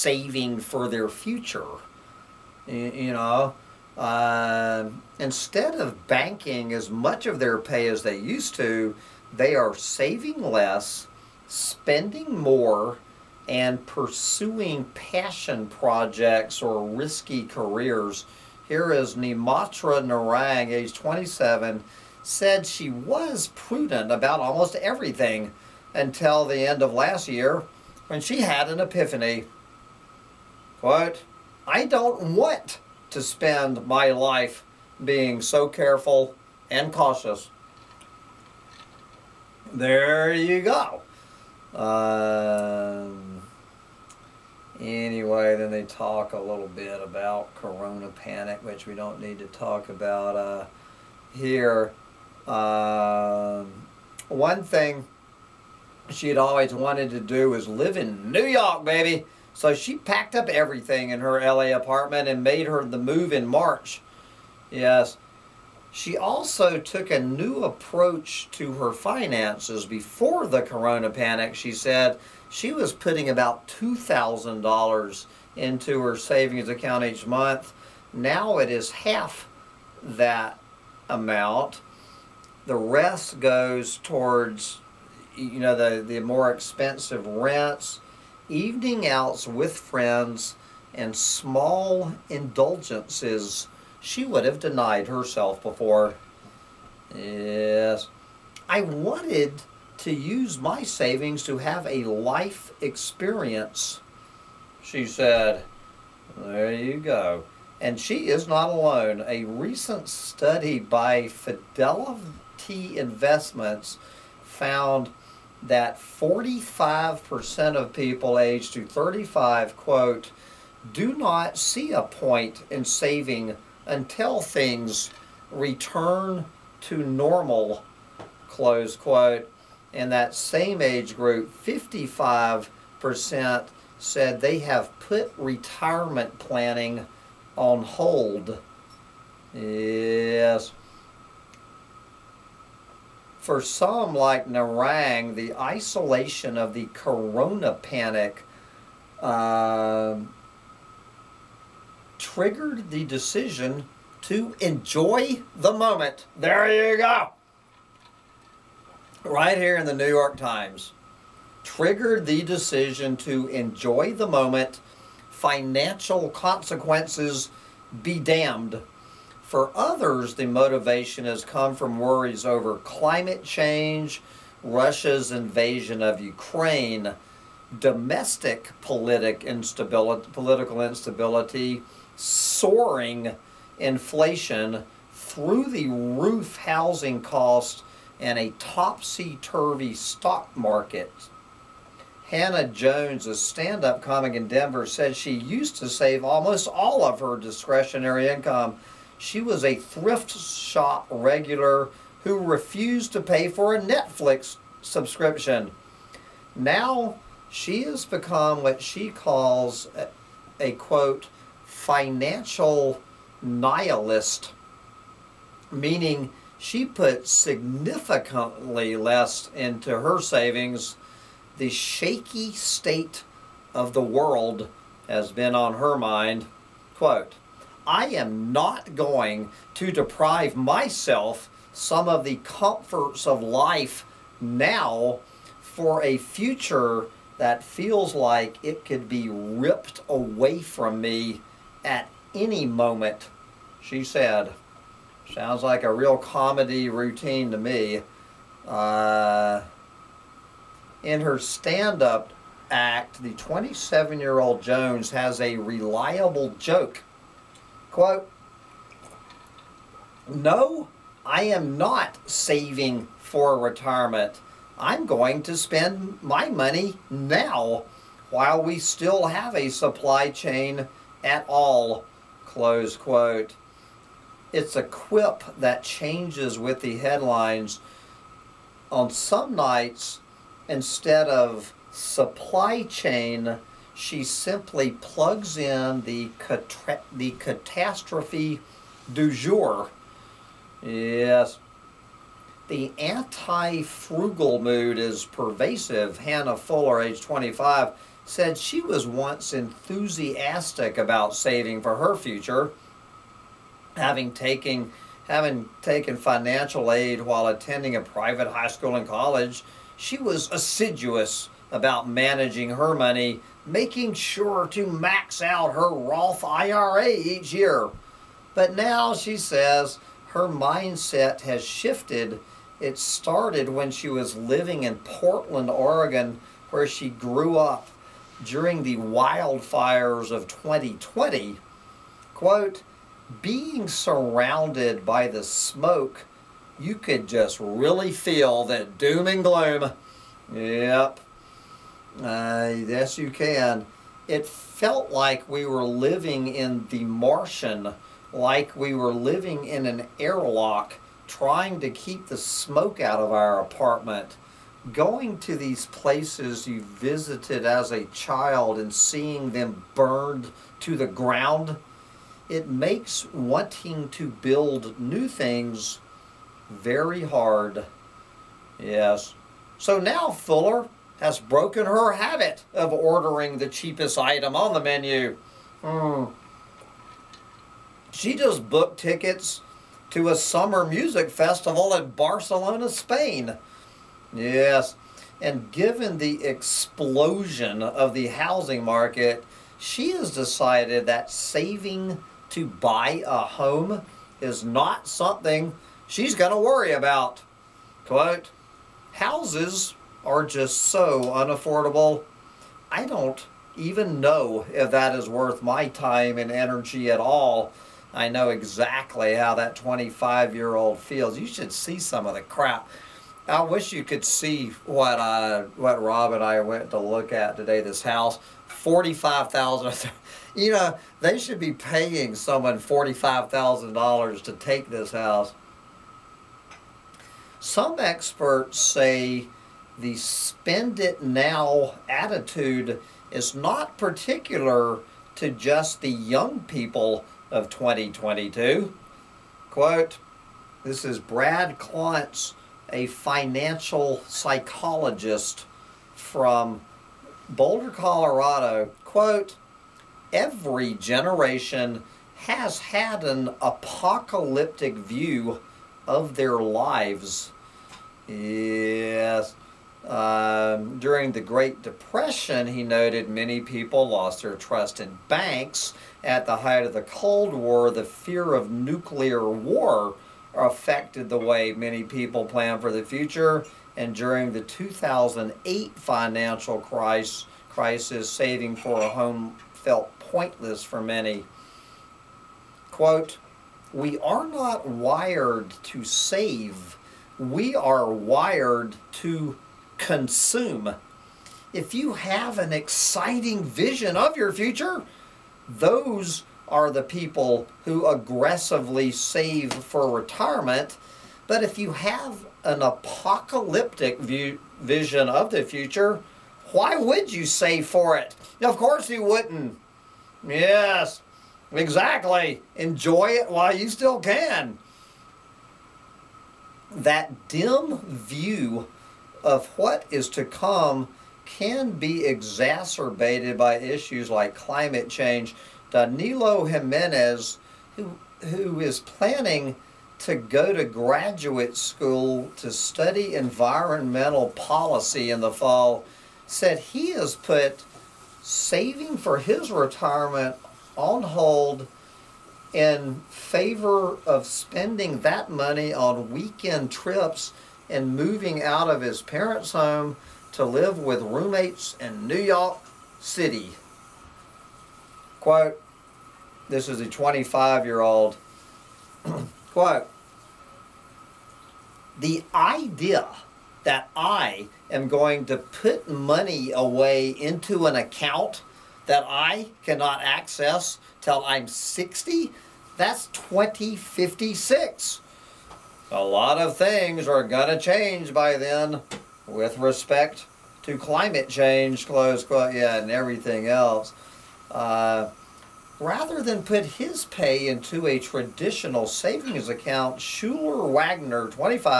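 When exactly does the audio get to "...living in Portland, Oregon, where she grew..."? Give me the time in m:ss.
5:24.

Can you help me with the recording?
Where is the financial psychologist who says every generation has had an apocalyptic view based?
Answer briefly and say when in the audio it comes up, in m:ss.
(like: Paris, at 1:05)
Boulder, Colorado, at 7:27.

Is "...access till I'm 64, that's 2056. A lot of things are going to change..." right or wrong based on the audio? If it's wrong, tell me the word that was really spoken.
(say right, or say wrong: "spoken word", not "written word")
wrong: "60", not "64".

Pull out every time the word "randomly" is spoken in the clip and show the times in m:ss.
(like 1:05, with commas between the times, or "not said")
not said.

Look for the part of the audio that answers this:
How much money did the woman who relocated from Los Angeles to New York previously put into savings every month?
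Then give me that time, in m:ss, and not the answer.
1:13.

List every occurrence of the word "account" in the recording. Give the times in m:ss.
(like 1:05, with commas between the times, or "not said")
1:16, 9:27, 9:49.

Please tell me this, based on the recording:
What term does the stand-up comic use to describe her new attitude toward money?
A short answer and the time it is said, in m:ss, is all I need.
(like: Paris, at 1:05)
financial nihilist, at 3:31.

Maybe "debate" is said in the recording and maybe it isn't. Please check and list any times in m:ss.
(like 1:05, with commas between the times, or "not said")
not said.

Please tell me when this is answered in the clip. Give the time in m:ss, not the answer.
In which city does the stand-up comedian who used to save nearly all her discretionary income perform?
3:14.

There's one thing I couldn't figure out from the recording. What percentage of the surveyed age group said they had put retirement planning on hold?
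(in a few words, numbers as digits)
55%.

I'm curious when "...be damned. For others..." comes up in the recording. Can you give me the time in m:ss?
2:48.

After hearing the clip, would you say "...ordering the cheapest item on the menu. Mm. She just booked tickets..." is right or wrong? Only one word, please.
right.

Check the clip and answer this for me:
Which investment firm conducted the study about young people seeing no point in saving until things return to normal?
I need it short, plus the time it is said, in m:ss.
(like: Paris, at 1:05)
Fidelity Investments, at 1:51.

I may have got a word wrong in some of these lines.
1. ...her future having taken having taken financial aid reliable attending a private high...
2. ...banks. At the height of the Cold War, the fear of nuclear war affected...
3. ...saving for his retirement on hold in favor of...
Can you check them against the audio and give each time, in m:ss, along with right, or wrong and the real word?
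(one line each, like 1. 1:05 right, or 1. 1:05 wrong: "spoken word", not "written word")
1. 5:01 wrong: "while", not "reliable"
2. 7:45 right
3. 8:58 right.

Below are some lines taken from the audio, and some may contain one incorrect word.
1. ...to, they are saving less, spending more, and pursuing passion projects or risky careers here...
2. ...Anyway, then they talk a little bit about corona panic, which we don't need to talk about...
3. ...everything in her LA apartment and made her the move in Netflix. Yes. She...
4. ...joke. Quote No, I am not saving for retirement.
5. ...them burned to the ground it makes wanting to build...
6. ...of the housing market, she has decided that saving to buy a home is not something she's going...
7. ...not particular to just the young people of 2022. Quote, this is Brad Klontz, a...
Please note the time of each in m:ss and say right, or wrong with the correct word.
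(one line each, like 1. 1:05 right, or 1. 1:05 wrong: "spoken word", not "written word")
1. 0:08 right
2. 0:44 right
3. 1:00 wrong: "March", not "Netflix"
4. 4:16 right
5. 5:59 right
6. 6:27 right
7. 7:13 right.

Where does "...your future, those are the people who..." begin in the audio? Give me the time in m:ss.
8:14.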